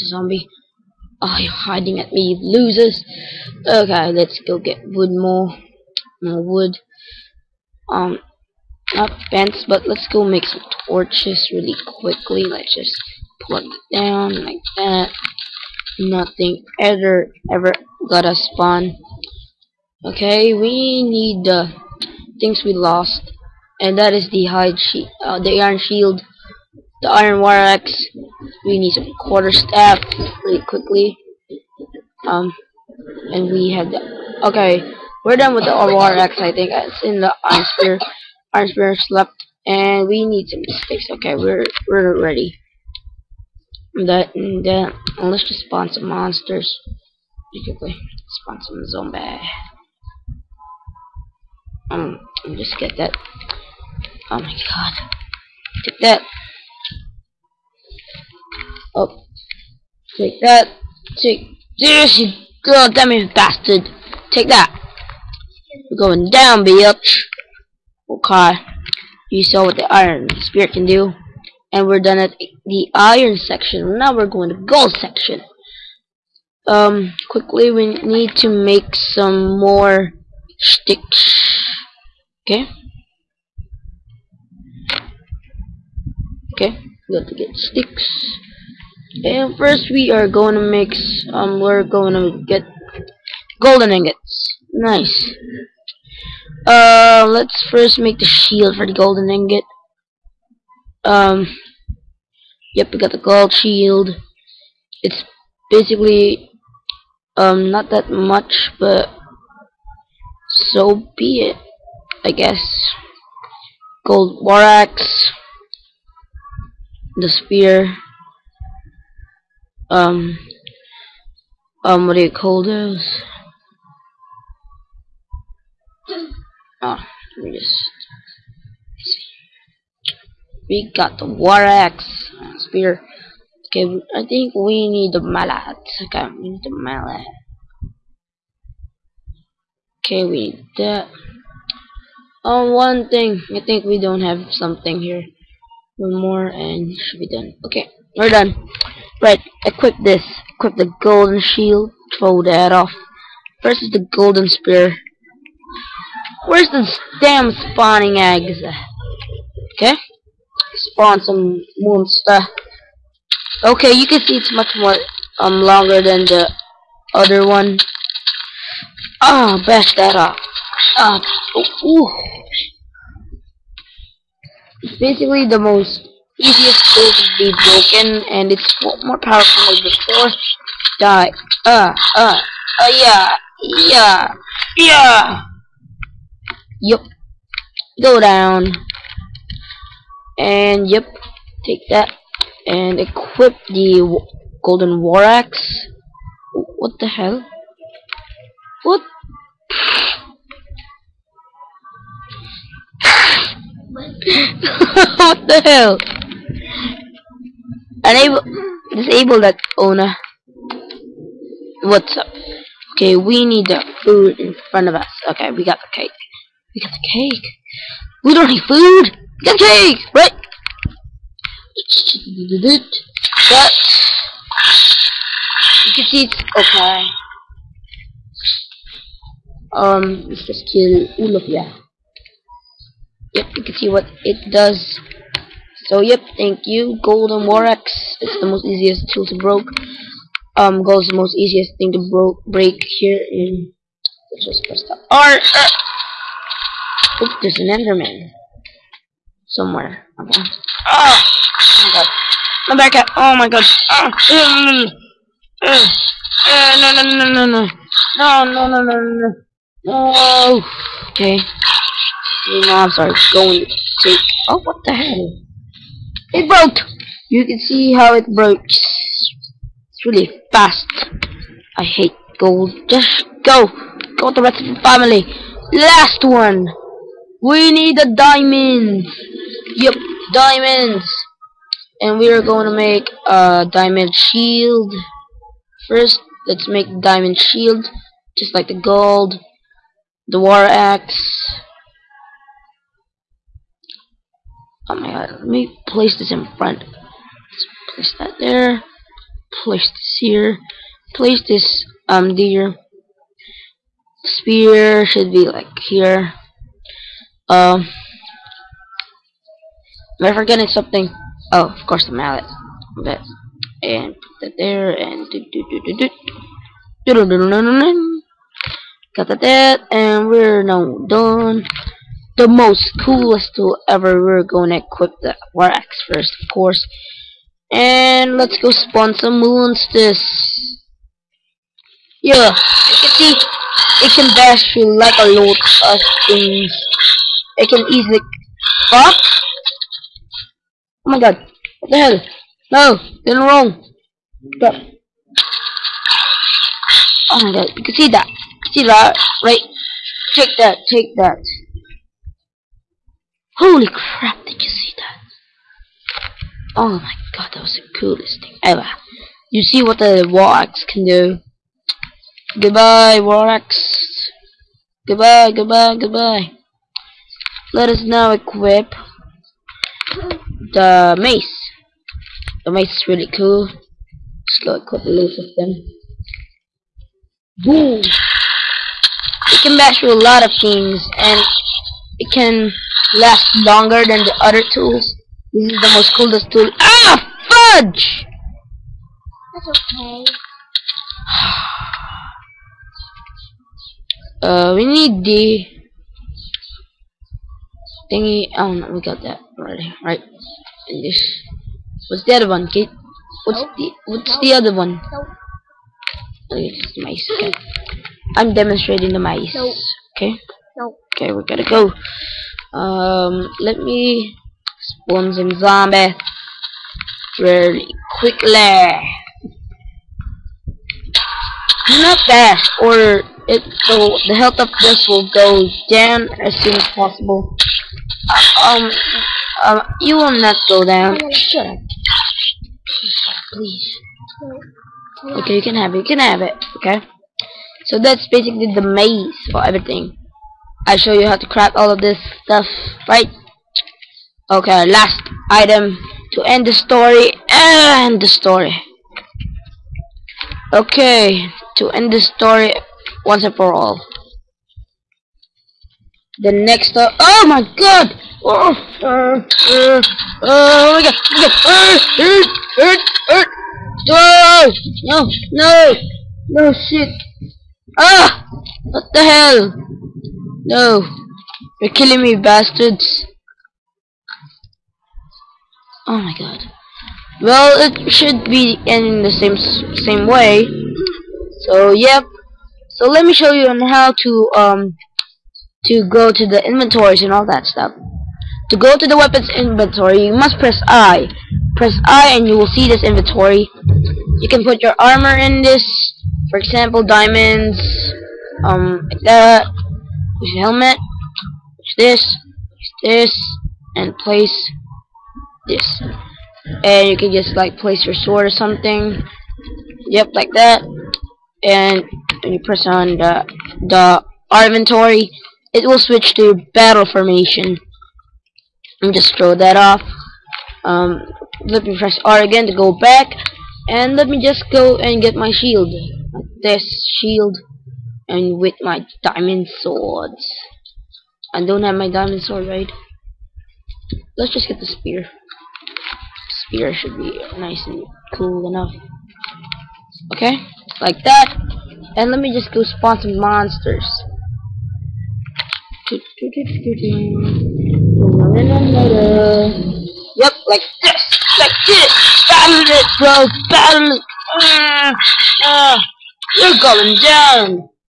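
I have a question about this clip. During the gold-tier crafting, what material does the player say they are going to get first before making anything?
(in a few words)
golden ingots.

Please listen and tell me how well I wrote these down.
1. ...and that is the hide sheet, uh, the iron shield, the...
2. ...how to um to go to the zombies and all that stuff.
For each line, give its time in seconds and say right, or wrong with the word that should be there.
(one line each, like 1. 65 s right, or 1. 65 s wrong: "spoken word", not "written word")
1. 23 s right
2. 483 s wrong: "inventories", not "zombies".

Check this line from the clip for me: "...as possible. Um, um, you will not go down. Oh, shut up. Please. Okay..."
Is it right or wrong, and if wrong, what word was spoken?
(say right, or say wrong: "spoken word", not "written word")
right.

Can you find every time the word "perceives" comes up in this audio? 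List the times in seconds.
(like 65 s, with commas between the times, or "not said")
not said.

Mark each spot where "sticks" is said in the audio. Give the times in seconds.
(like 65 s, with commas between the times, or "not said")
40 s, 80 s, 87 s.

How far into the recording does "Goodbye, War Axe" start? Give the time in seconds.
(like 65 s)
362 s.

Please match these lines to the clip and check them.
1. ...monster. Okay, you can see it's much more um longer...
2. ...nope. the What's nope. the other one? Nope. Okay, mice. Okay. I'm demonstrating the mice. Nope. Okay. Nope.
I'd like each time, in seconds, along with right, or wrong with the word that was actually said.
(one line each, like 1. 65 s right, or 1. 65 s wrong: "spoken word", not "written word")
1. 161 s right
2. 403 s right.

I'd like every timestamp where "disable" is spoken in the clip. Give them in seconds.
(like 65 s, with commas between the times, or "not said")
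208 s.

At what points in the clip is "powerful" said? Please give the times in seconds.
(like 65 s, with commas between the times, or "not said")
179 s.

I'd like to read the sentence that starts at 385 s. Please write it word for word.
This is the most coolest tool.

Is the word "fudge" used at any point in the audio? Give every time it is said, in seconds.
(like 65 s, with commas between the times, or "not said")
387 s.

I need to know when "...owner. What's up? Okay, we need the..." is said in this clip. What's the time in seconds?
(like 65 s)
209 s.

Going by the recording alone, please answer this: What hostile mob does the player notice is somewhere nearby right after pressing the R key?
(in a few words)
Enderman.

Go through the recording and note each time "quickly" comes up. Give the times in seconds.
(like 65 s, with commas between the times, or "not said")
12 s, 30 s, 47 s, 77 s, 418 s.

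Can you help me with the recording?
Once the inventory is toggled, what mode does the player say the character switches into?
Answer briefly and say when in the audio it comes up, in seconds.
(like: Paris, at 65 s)
battle formation, at 516 s.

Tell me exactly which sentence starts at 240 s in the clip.
Um, gold is the most easiest thing to broke break here in.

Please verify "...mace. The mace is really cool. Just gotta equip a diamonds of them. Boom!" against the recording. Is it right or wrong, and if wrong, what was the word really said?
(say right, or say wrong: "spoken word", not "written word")
wrong: "loads", not "diamonds".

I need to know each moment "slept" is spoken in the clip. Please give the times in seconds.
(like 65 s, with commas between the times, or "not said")
38 s.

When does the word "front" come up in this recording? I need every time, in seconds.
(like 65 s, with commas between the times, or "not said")
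214 s.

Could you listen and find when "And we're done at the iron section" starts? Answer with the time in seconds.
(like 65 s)
71 s.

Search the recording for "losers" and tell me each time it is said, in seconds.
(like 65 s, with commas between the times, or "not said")
2 s.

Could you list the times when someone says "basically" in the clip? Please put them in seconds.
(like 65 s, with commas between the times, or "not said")
105 s, 174 s, 438 s.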